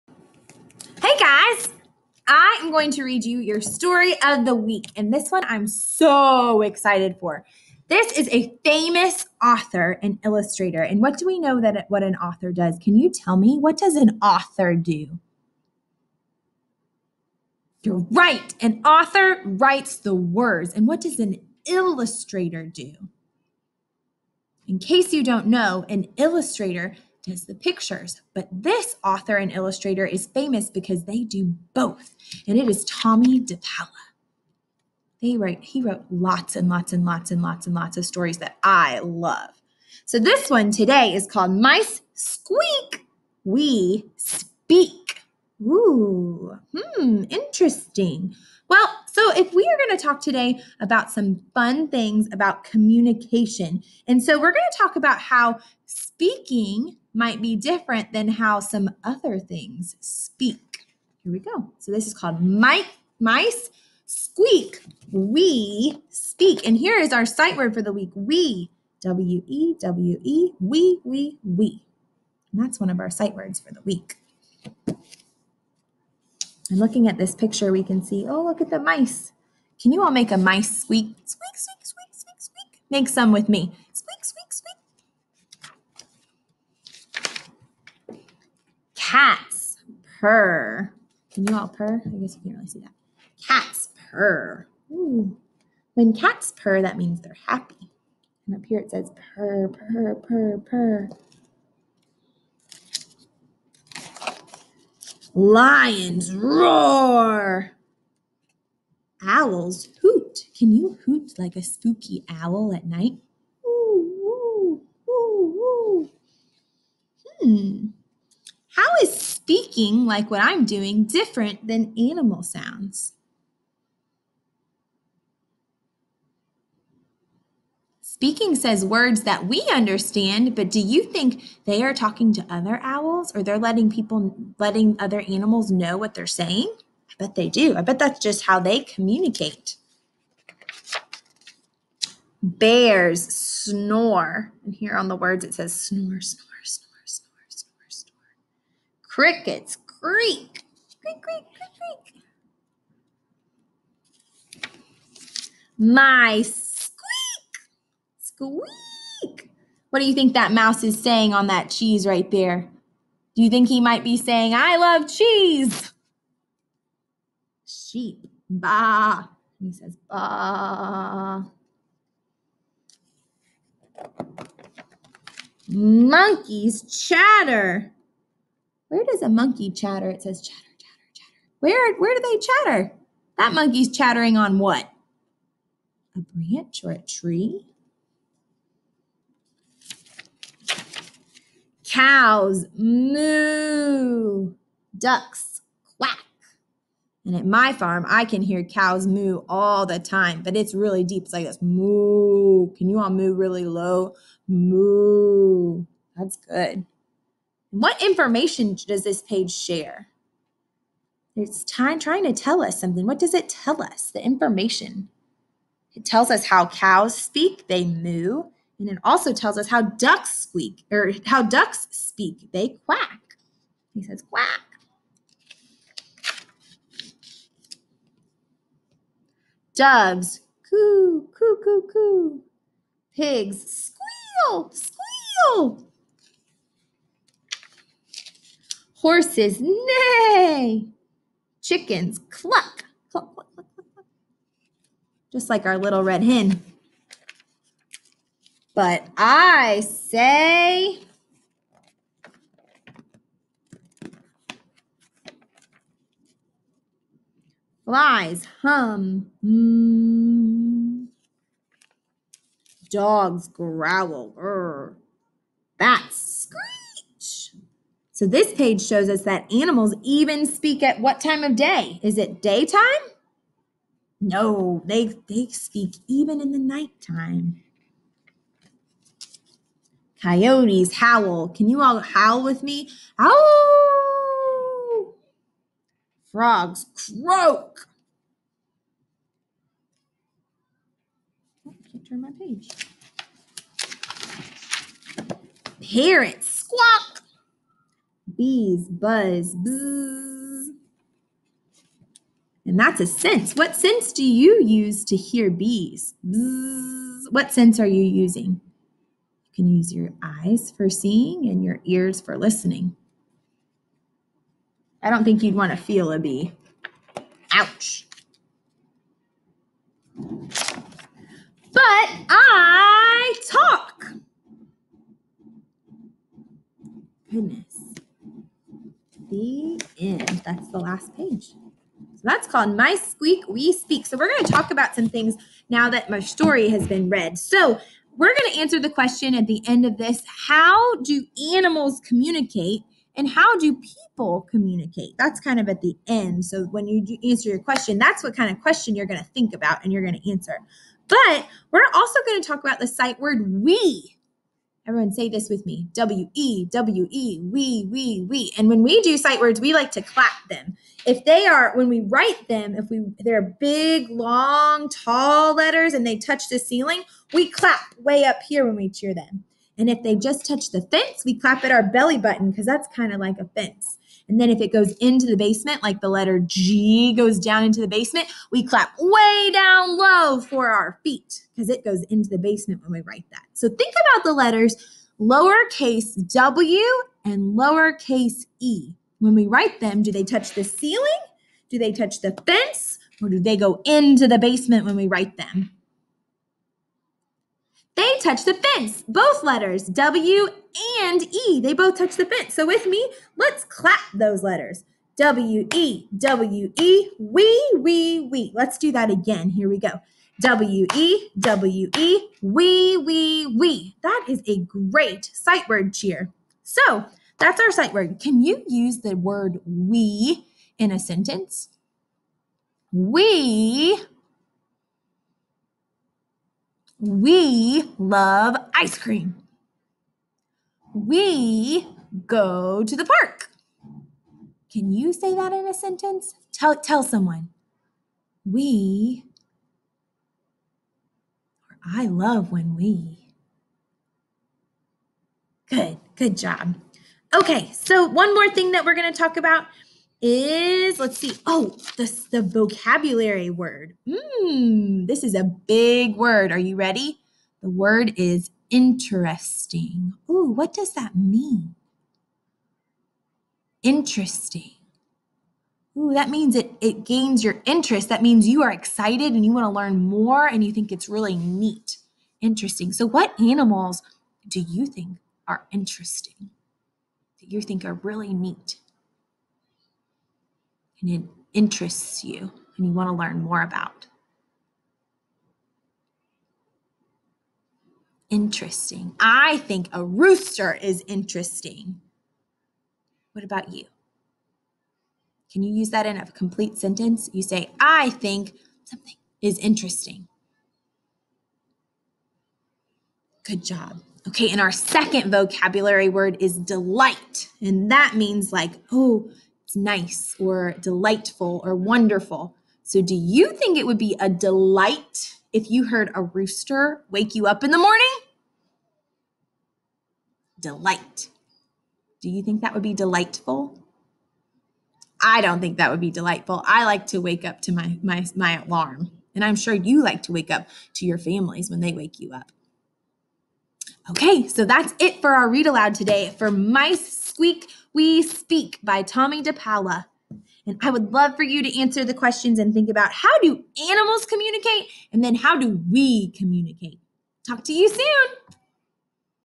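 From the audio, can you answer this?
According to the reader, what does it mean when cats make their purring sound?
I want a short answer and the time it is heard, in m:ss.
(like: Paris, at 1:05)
they're happy, at 1:37.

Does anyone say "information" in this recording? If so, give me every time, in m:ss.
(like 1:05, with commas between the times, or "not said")
3:28, 3:34.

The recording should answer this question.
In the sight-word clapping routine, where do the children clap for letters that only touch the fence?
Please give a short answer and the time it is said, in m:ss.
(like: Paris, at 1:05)
belly button, at 6:11.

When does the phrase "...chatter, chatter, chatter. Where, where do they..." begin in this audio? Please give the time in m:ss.
3:00.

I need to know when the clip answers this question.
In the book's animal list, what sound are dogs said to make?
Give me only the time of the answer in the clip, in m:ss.
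4:23.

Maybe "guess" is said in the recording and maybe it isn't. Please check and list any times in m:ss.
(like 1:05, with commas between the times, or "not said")
1:32.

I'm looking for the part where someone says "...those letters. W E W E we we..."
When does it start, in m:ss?
6:44.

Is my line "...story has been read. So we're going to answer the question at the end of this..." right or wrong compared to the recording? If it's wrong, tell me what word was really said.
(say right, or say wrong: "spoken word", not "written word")
right.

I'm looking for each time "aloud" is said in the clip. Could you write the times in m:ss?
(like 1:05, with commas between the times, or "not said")
8:55.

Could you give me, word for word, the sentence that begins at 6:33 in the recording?
Or do they go into the basement when we write them?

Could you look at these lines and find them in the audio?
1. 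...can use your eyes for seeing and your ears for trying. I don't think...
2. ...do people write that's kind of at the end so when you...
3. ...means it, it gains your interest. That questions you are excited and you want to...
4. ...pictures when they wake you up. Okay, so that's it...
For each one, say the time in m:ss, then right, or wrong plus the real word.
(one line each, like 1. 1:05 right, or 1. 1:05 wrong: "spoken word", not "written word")
1. 5:09 wrong: "listening", not "trying"
2. 5:43 wrong: "communicate", not "write"
3. 7:46 wrong: "means", not "questions"
4. 8:51 wrong: "families", not "pictures".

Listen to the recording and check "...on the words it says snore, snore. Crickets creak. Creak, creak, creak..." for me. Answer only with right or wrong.
right.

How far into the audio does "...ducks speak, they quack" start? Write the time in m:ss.
3:41.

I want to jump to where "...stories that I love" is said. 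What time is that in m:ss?
0:38.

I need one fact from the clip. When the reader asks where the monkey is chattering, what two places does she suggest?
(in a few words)
A branch or a tree.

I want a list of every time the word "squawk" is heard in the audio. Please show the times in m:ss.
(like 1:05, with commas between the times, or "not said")
4:56.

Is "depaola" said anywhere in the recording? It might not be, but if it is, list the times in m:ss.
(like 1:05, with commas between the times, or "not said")
0:33, 8:59.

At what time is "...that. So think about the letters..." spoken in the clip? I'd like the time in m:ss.
6:23.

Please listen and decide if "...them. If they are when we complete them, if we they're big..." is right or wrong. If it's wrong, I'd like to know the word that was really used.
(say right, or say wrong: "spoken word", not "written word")
wrong: "write", not "complete".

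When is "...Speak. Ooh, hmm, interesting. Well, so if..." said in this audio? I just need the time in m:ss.
0:44.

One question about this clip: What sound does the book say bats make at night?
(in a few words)
scream.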